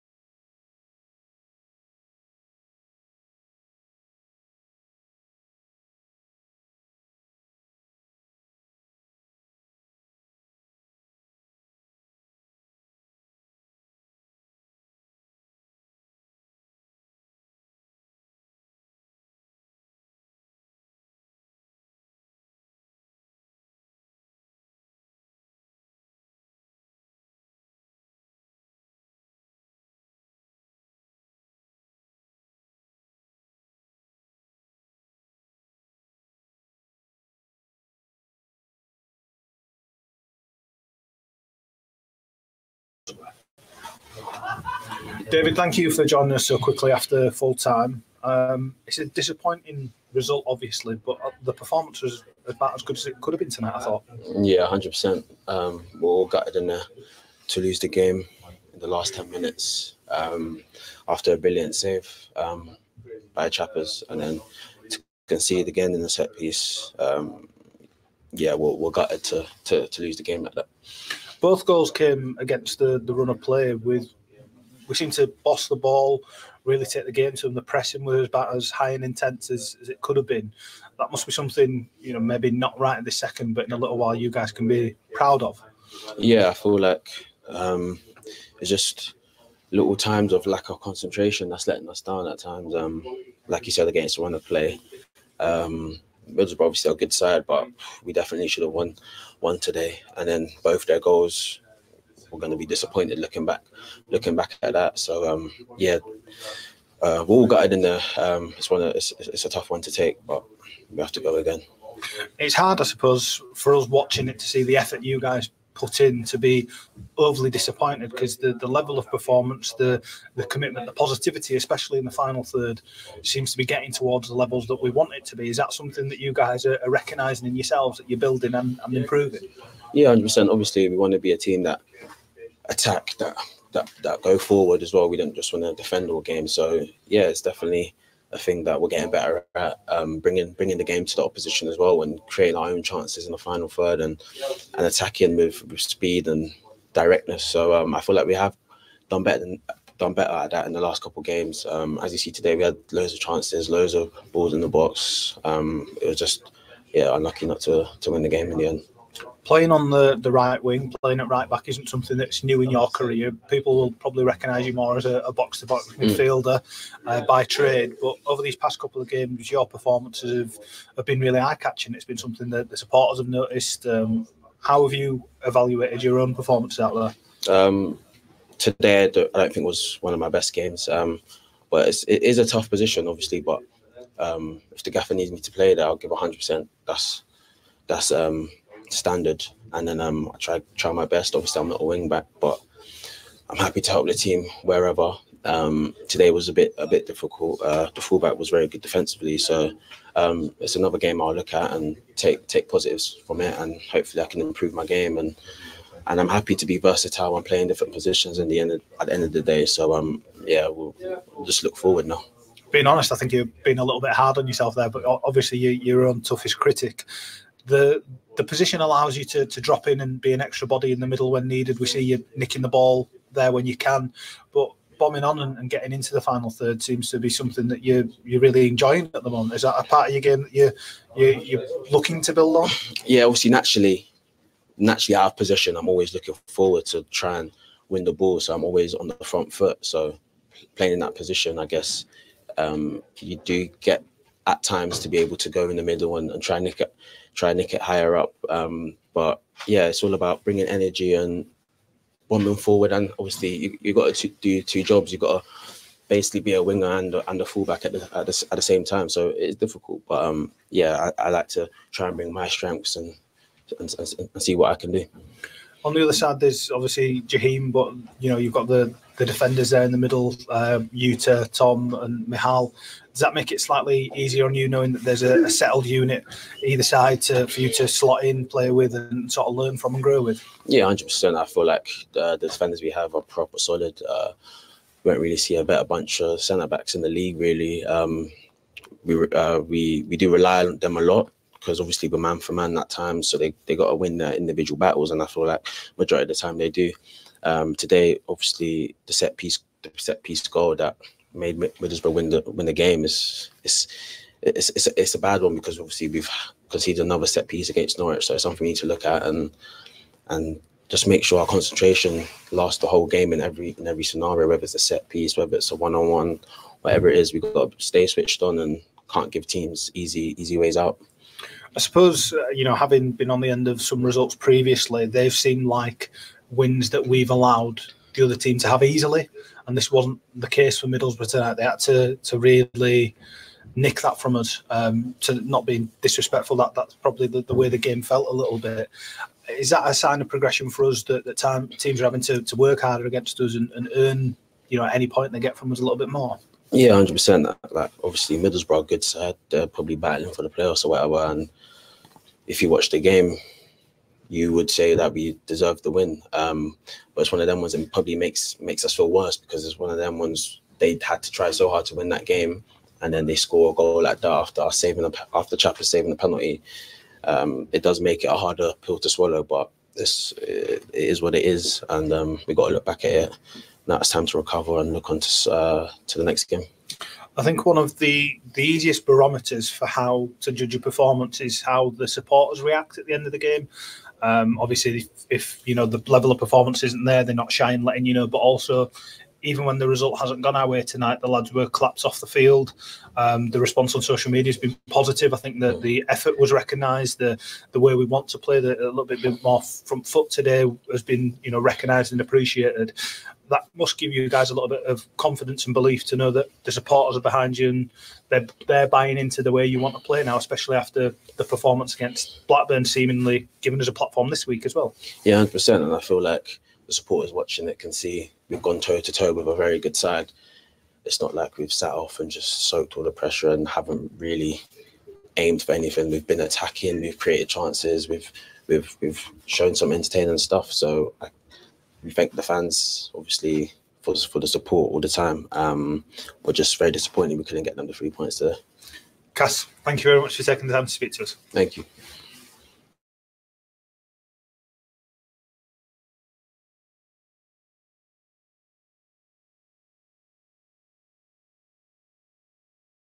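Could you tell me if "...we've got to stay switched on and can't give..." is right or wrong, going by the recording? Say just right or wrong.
right.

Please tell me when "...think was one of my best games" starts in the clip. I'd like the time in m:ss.
2:59.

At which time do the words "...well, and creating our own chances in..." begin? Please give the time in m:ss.
2:21.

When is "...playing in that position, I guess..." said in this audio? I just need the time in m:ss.
4:00.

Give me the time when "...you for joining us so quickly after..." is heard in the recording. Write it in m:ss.
0:45.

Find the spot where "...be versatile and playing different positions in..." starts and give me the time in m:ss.
3:26.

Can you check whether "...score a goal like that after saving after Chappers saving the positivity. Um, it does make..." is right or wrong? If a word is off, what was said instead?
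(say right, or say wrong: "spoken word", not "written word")
wrong: "penalty", not "positivity".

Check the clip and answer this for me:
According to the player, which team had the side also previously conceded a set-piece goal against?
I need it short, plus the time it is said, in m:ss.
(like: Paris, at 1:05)
Norwich, at 5:07.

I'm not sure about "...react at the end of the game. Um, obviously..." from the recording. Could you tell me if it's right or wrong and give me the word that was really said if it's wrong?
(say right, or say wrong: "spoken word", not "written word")
right.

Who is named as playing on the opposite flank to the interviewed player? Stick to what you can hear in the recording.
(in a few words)
Jaheim.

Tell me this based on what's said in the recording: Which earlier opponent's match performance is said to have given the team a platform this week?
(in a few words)
Blackburn.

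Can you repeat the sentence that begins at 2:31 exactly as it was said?
Um, as you see today, we had loads of chances, loads of balls in the box.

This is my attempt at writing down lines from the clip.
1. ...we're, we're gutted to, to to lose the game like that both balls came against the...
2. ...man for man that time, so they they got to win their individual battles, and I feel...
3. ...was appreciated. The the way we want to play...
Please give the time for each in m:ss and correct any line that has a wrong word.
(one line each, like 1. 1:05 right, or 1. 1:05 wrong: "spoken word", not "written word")
1. 1:08 wrong: "goals", not "balls"
2. 4:52 right
3. 6:36 wrong: "recognised", not "appreciated".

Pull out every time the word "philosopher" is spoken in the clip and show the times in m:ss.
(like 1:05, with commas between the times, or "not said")
not said.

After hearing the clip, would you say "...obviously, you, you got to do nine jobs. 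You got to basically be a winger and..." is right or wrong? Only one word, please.
wrong.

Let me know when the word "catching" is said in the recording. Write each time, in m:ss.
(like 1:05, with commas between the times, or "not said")
2:51.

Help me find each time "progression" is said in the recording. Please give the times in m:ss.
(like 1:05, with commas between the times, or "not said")
5:40.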